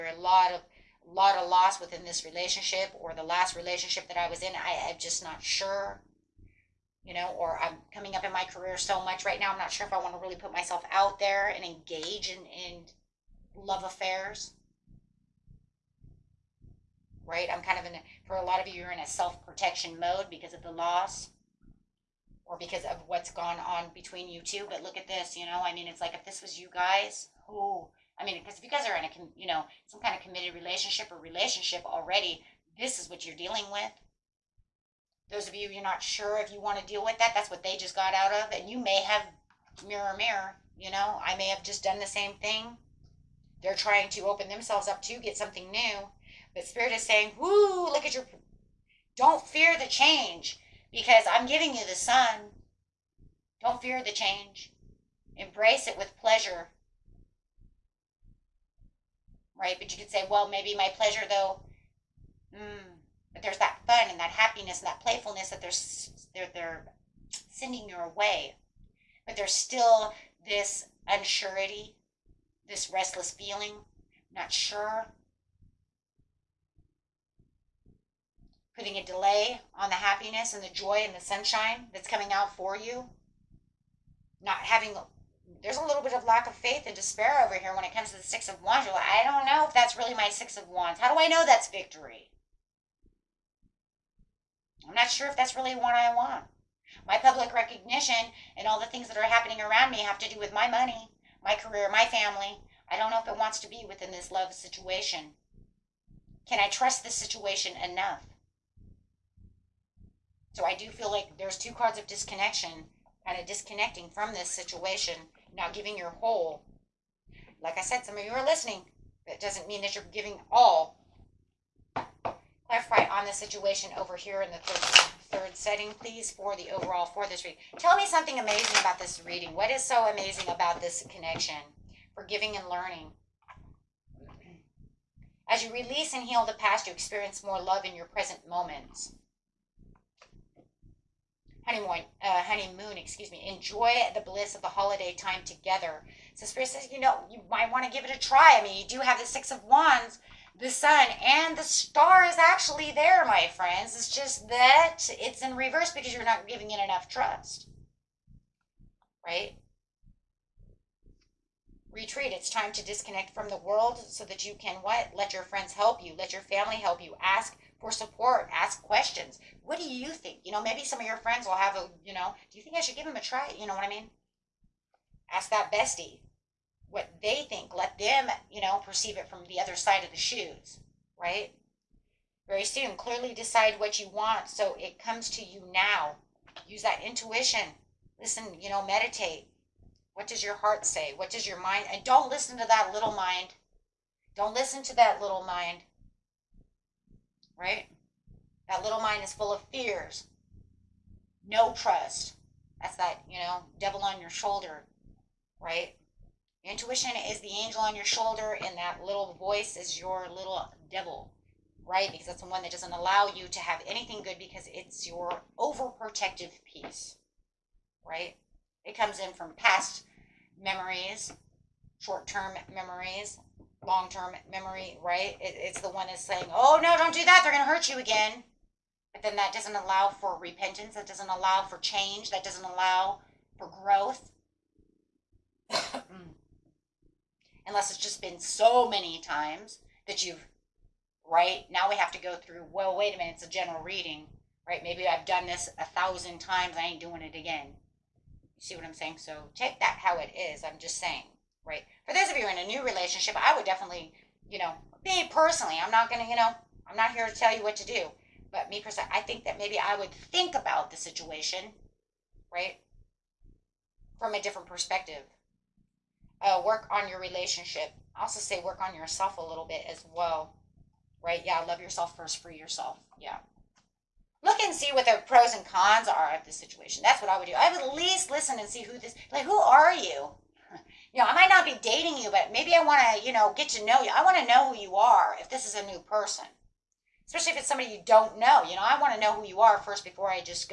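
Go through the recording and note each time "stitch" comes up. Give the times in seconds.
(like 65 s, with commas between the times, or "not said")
not said.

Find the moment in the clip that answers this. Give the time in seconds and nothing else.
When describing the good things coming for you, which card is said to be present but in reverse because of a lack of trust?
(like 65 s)
151 s.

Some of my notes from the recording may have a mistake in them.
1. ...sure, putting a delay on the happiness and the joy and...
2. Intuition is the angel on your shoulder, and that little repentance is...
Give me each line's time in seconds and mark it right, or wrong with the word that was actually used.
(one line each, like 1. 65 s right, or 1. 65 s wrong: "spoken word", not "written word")
1. 74 s right
2. 206 s wrong: "voice", not "repentance".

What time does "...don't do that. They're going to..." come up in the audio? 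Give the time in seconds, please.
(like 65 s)
226 s.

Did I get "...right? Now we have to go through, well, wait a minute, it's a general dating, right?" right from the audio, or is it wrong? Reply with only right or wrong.
wrong.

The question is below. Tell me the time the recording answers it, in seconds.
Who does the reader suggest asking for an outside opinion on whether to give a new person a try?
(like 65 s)
175 s.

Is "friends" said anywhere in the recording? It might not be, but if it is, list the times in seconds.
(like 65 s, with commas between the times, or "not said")
153 s, 165 s, 171 s.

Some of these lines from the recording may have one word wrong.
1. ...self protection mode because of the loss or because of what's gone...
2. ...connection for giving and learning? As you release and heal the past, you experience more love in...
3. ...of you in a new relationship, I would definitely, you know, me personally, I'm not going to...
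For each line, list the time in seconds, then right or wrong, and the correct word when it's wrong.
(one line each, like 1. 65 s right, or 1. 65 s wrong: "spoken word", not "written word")
1. 19 s right
2. 131 s right
3. 252 s right.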